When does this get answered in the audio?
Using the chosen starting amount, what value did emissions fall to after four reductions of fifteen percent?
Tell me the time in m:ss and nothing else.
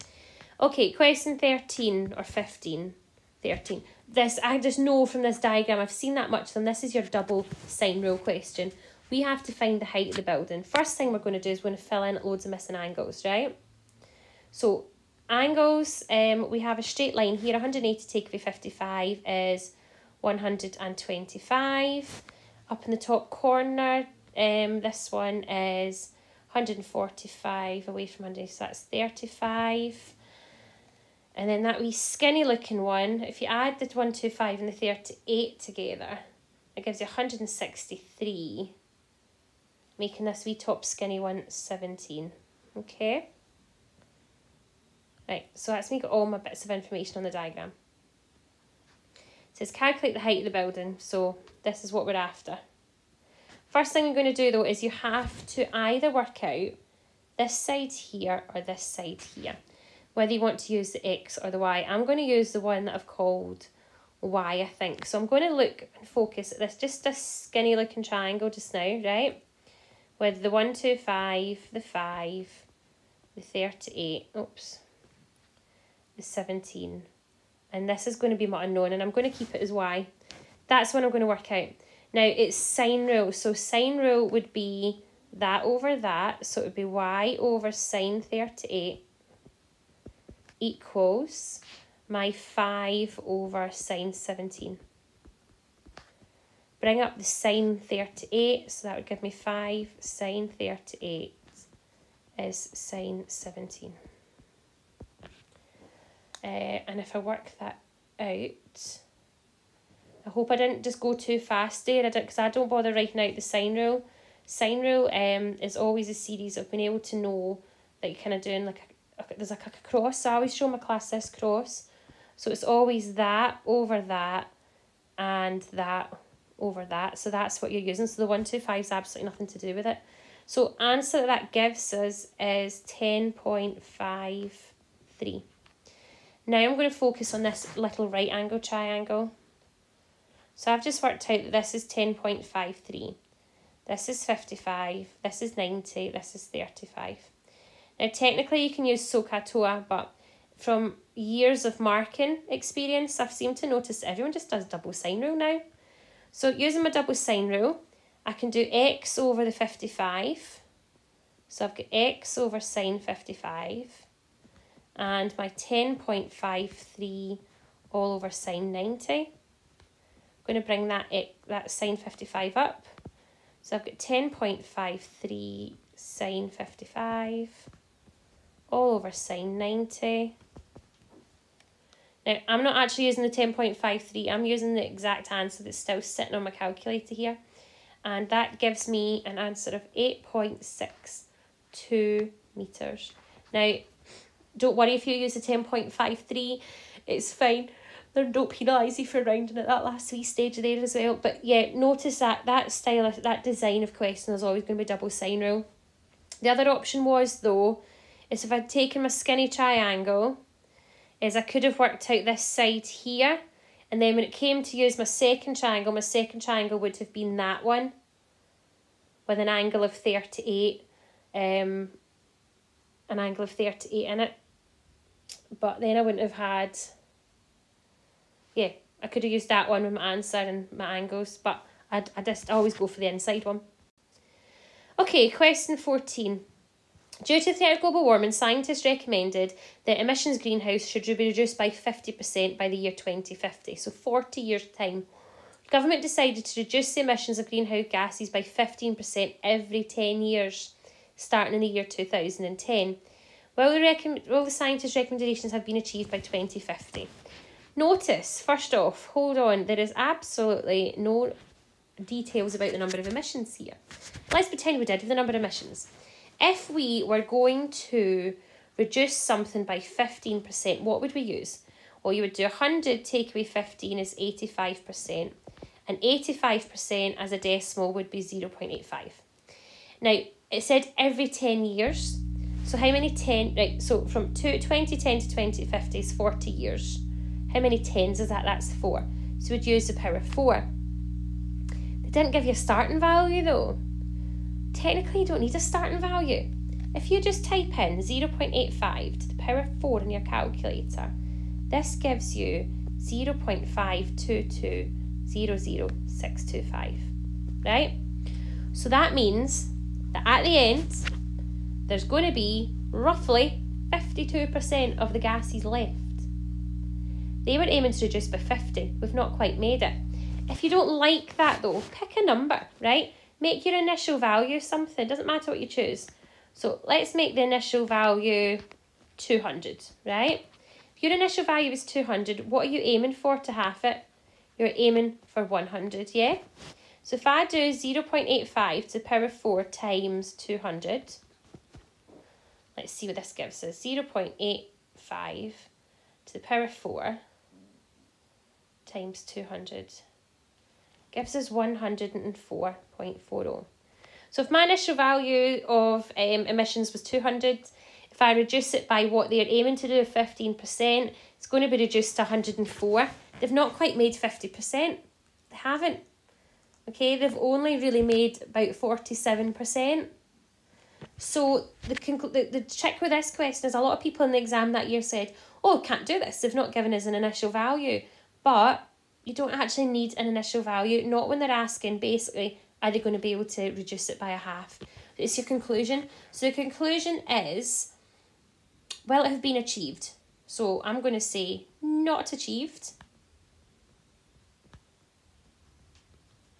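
5:51.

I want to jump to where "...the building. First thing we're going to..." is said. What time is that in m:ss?
0:10.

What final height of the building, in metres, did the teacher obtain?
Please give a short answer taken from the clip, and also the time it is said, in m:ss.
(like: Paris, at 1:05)
8.62 metres, at 3:09.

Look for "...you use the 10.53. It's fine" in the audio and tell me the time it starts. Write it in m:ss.
3:15.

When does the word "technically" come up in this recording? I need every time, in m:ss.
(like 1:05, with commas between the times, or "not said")
2:28, 4:54.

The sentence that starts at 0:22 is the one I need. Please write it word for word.
Up in the top corner, um, this one is 145 away from 100, so that's 35.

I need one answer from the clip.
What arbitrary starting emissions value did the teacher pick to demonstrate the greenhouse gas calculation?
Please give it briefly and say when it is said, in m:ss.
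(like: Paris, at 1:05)
200, at 5:26.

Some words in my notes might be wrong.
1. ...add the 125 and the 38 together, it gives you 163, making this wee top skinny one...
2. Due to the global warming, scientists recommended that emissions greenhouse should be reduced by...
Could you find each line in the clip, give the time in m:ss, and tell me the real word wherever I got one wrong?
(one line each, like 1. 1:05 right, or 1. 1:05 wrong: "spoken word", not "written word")
1. 0:33 right
2. 3:57 right.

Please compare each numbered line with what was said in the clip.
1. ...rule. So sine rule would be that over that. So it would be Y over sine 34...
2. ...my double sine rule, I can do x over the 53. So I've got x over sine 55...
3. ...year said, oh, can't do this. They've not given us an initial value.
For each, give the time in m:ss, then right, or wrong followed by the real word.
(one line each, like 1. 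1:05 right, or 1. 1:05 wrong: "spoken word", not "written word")
1. 1:23 wrong: "38", not "34"
2. 2:36 wrong: "55", not "53"
3. 6:14 right.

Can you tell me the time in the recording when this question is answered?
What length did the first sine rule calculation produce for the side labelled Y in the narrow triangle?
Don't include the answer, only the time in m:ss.
2:11.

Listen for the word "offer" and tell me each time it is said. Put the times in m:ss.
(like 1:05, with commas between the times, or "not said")
not said.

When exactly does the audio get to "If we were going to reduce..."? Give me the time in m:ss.
4:26.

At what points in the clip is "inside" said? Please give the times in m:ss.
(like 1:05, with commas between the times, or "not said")
3:53.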